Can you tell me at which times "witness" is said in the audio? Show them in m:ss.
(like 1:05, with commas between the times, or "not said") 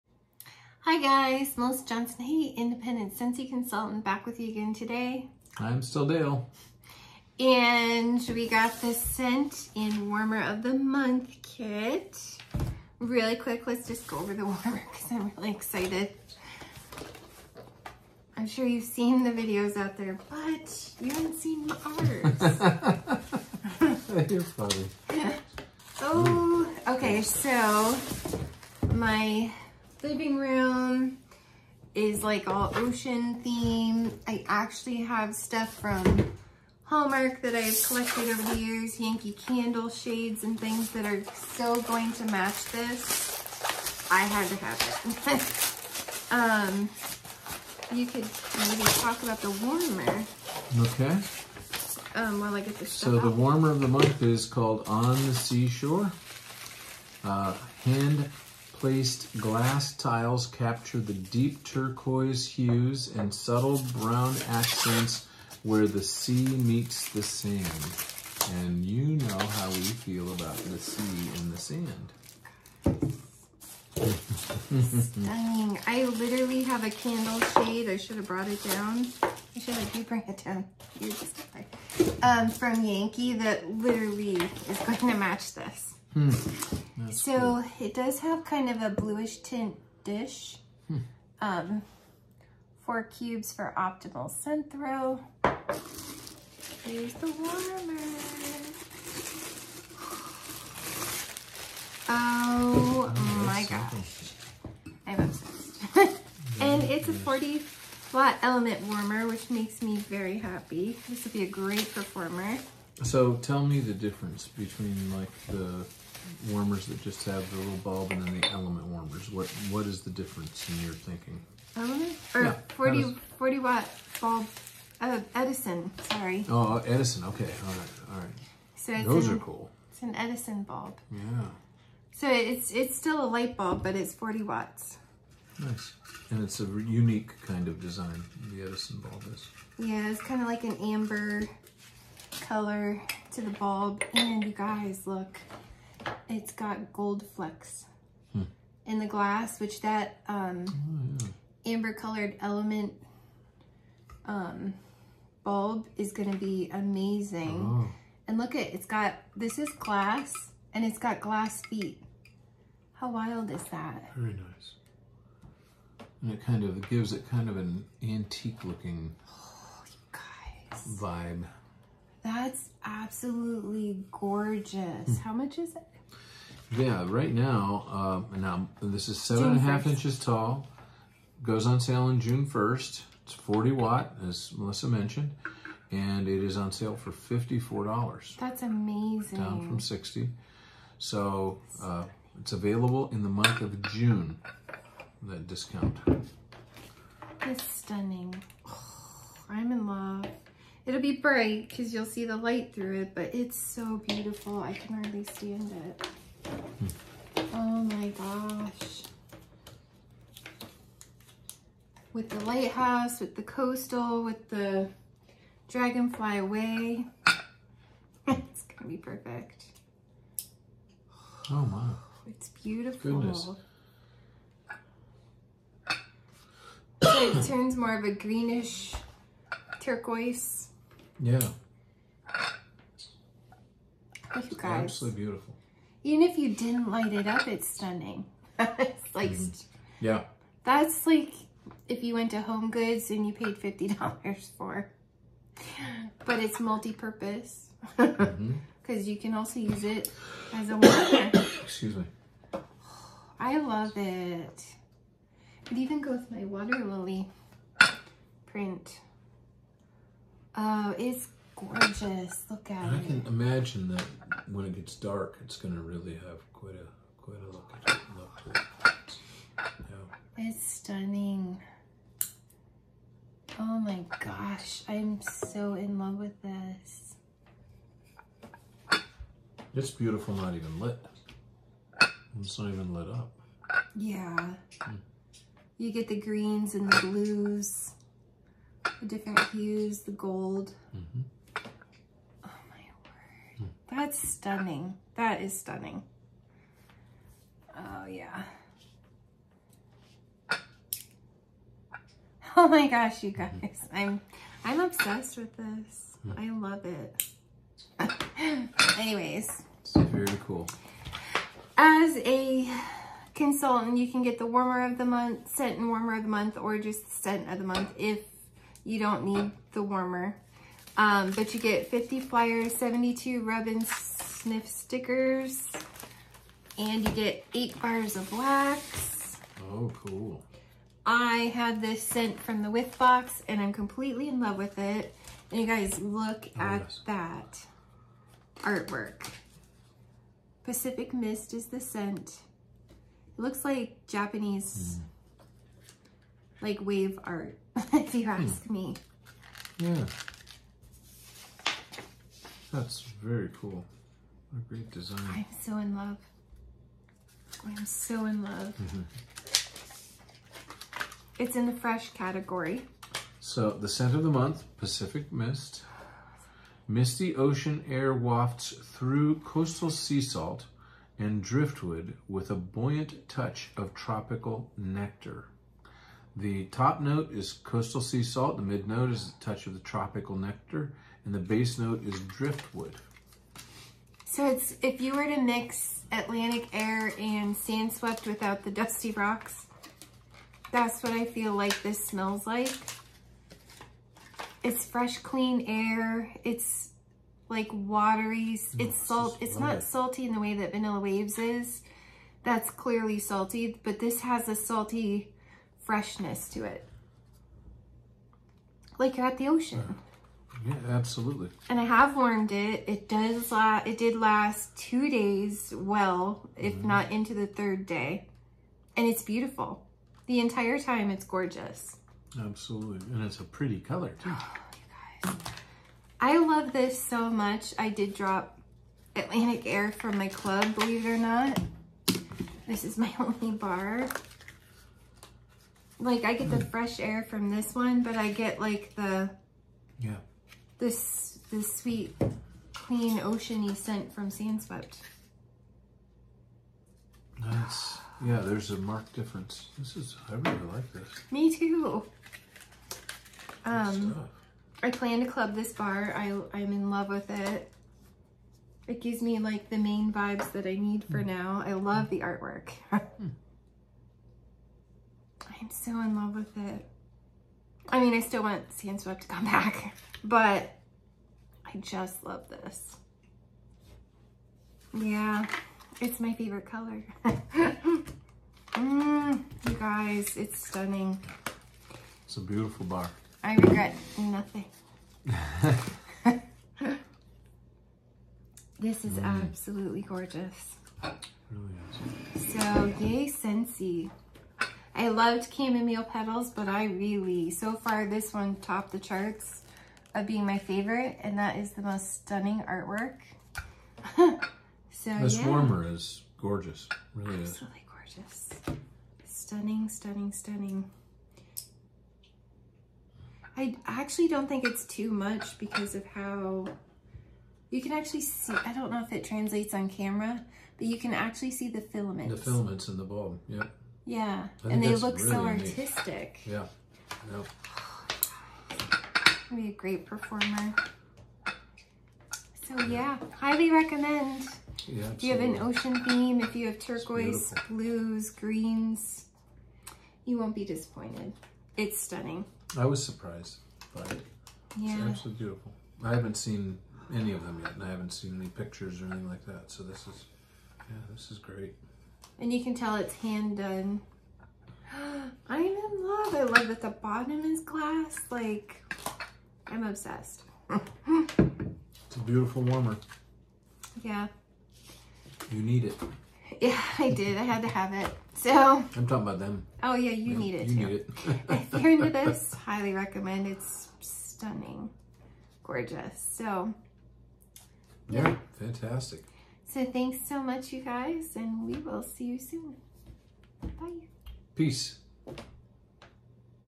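not said.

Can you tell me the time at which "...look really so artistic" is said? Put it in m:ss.
8:44.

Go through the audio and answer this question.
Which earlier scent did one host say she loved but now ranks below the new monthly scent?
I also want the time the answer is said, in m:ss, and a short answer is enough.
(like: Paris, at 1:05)
Chamomile Petals, at 8:15.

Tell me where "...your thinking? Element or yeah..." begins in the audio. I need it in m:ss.
2:00.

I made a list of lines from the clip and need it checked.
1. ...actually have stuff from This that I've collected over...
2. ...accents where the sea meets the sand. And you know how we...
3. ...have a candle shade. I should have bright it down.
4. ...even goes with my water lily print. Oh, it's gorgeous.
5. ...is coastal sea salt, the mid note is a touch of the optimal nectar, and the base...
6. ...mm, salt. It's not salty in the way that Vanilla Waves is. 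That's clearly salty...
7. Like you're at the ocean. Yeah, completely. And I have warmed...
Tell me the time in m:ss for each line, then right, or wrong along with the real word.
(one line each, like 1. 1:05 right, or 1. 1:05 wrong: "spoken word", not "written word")
1. 0:34 wrong: "Hallmark", not "This"
2. 1:04 right
3. 1:16 wrong: "brought", not "bright"
4. 4:15 right
5. 6:17 wrong: "tropical", not "optimal"
6. 6:38 right
7. 6:48 wrong: "absolutely", not "completely".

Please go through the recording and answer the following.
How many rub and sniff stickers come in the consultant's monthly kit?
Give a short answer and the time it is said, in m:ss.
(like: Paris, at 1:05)
72, at 5:22.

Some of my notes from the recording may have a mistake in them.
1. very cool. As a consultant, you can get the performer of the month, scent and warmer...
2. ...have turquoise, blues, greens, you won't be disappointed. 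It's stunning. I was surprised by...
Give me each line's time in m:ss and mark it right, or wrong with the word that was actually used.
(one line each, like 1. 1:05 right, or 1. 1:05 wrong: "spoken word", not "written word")
1. 5:09 wrong: "warmer", not "performer"
2. 8:56 right.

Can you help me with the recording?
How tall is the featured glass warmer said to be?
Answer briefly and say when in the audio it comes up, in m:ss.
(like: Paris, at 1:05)
7.5 inches, at 2:59.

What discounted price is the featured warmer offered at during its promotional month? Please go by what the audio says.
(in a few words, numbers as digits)
$54.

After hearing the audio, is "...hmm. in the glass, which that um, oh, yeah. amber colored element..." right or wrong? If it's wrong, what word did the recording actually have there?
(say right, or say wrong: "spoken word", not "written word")
right.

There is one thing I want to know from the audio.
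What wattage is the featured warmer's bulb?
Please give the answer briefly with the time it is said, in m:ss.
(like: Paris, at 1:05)
40, at 1:46.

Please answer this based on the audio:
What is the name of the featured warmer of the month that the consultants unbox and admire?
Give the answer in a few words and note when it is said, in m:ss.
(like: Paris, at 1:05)
On the Seashore, at 0:54.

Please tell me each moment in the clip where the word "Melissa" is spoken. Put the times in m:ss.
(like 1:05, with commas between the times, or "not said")
0:01, 3:04.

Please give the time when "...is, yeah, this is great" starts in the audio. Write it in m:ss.
9:10.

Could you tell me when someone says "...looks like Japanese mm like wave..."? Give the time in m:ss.
5:43.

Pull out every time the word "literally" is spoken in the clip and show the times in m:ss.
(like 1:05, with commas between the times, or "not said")
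1:16, 1:23.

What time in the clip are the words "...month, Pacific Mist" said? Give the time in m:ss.
6:04.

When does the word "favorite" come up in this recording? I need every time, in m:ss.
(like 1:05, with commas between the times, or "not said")
7:56, 8:20.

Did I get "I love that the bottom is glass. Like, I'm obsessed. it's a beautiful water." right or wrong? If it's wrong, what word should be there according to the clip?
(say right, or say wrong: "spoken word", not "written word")
wrong: "warmer", not "water".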